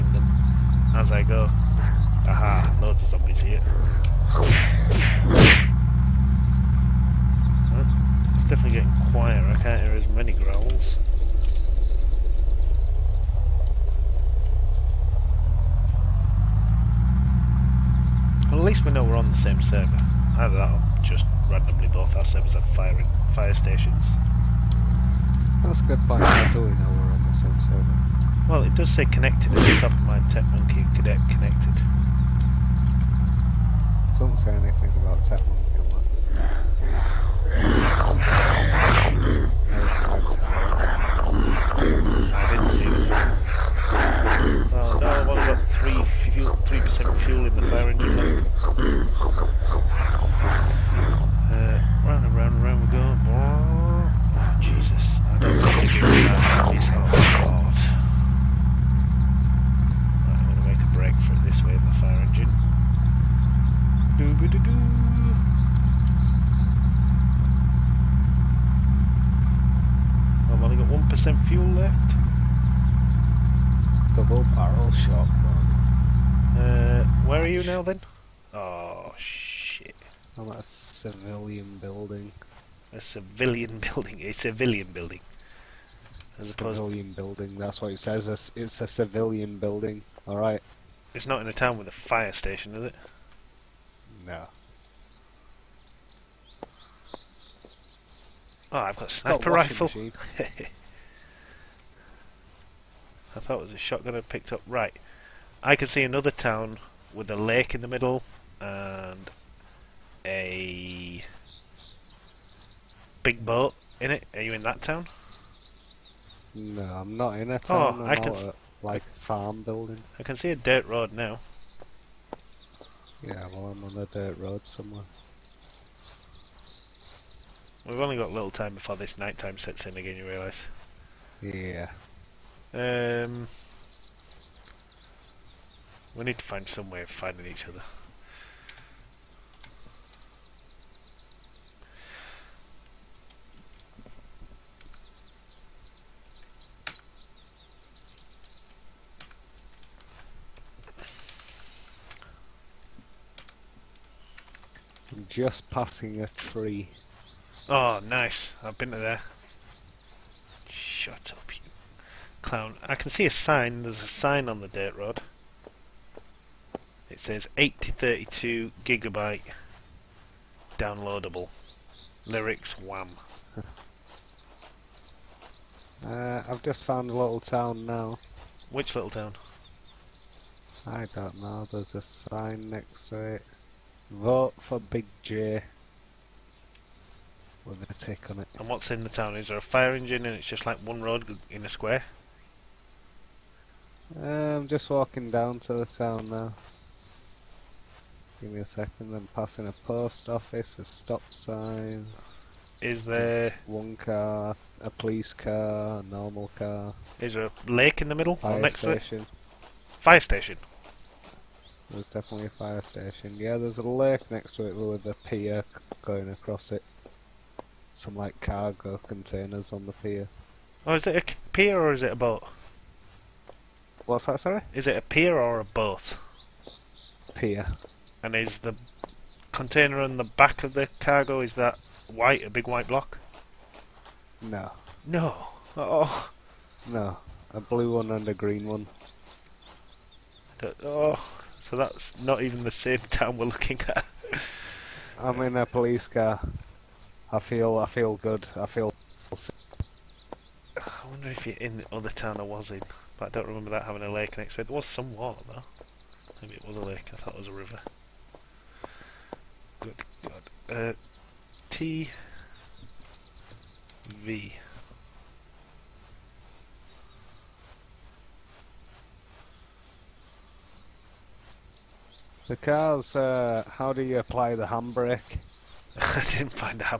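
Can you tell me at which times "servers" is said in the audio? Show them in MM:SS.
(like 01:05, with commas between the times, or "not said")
00:22, 00:27.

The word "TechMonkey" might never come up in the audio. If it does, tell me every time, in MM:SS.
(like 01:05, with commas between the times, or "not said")
00:30, 00:35.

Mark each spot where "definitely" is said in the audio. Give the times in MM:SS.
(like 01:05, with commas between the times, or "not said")
03:32.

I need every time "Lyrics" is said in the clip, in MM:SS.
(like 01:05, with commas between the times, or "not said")
02:52.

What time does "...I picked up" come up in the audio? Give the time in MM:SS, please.
01:44.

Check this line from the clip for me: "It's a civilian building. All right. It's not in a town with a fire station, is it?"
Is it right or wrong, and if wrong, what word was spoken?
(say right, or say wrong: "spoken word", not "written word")
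right.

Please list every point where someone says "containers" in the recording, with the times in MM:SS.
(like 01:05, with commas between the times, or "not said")
03:39, 03:49.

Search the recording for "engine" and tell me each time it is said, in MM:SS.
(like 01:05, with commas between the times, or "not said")
00:47, 03:09.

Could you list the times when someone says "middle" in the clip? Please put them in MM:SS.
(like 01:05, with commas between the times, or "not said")
01:47, 03:28.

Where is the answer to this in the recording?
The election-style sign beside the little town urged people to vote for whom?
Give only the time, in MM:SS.
03:04.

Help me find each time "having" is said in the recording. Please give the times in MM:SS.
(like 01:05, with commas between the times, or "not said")
04:13.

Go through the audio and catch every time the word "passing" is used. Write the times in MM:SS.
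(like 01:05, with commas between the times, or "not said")
02:35, 03:19.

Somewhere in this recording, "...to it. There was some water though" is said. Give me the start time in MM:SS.
04:14.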